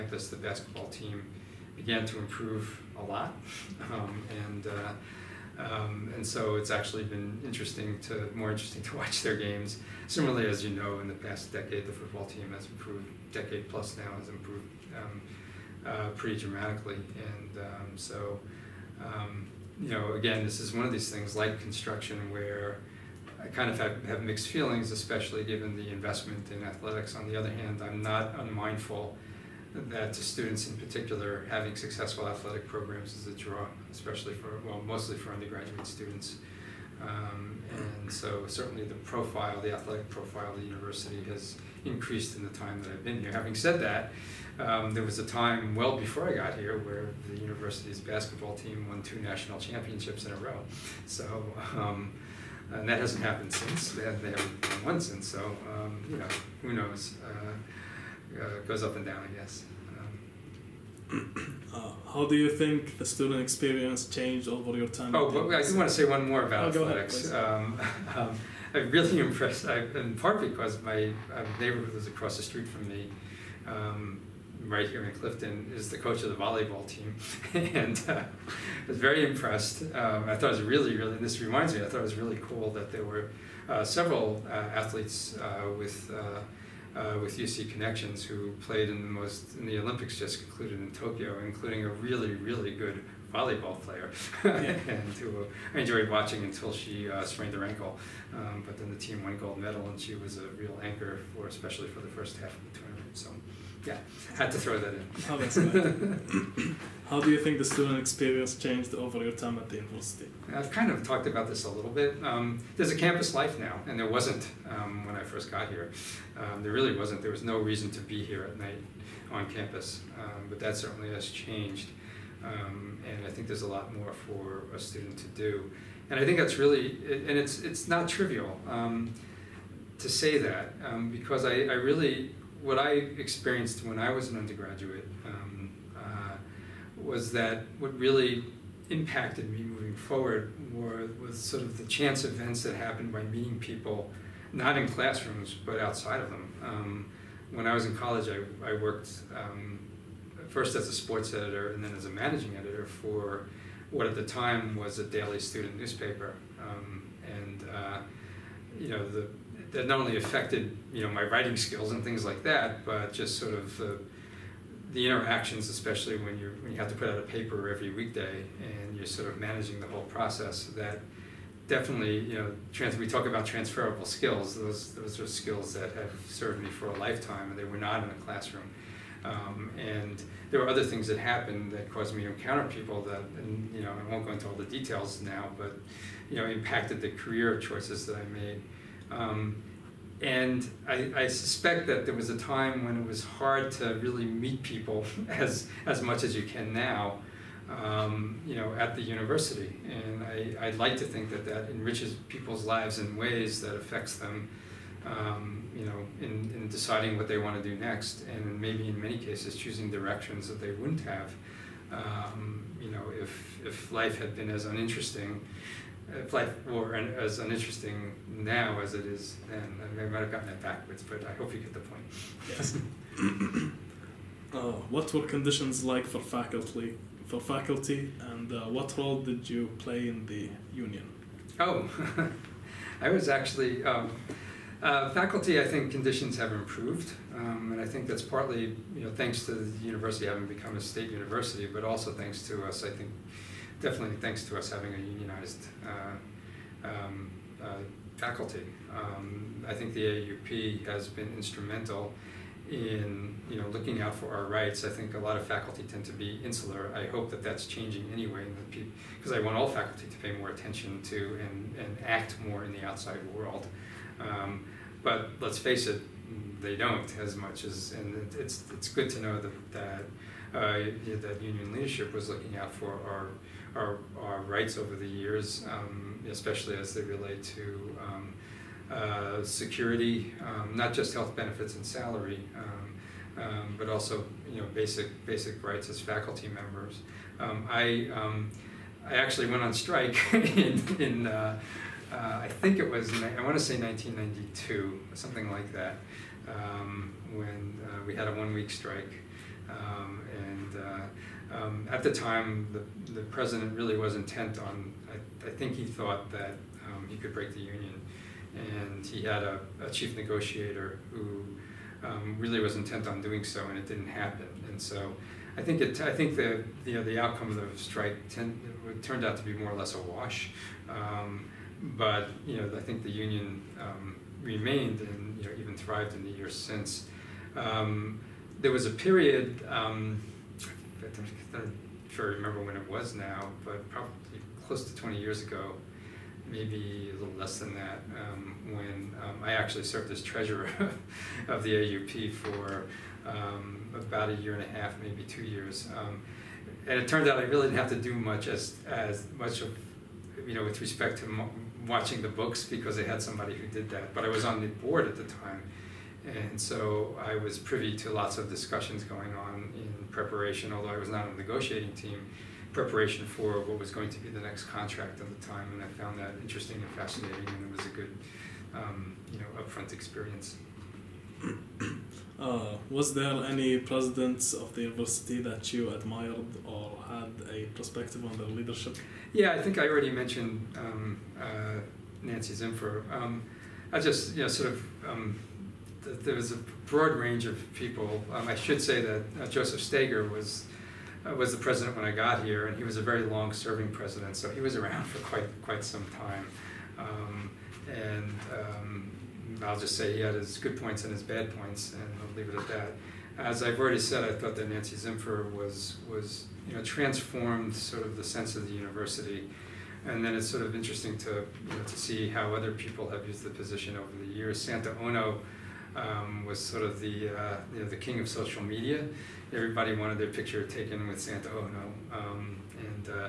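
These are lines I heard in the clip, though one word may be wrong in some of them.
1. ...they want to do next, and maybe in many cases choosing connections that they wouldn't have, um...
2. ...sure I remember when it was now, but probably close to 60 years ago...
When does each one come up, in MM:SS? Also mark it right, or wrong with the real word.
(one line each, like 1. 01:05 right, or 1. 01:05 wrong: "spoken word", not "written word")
1. 03:27 wrong: "directions", not "connections"
2. 05:32 wrong: "20", not "60".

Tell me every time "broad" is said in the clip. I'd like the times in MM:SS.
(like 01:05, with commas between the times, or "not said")
06:26.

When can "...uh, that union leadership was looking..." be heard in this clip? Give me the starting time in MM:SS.
04:30.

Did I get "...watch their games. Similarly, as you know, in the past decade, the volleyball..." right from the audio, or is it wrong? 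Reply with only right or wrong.
wrong.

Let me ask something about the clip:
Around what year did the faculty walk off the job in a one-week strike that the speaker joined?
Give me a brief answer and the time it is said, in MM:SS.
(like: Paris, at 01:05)
1992, at 04:53.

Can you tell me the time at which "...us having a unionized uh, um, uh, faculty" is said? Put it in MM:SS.
04:04.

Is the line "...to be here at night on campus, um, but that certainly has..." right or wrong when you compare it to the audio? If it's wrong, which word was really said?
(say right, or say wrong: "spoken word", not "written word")
right.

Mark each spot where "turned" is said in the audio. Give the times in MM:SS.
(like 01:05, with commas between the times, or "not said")
05:19, 05:47.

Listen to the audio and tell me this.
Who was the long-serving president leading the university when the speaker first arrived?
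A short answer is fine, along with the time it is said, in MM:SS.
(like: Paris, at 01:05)
Joseph Steger, at 06:29.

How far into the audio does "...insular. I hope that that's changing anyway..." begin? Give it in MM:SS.
04:16.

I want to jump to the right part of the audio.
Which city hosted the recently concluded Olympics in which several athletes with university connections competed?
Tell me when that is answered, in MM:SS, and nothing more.
01:30.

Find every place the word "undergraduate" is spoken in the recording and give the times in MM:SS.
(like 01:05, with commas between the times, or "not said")
00:35, 02:14.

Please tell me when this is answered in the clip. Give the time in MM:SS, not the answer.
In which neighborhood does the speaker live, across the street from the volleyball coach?
01:15.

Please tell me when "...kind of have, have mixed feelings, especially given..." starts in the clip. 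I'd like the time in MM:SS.
00:23.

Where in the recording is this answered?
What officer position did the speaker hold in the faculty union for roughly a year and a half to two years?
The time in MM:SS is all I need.
05:40.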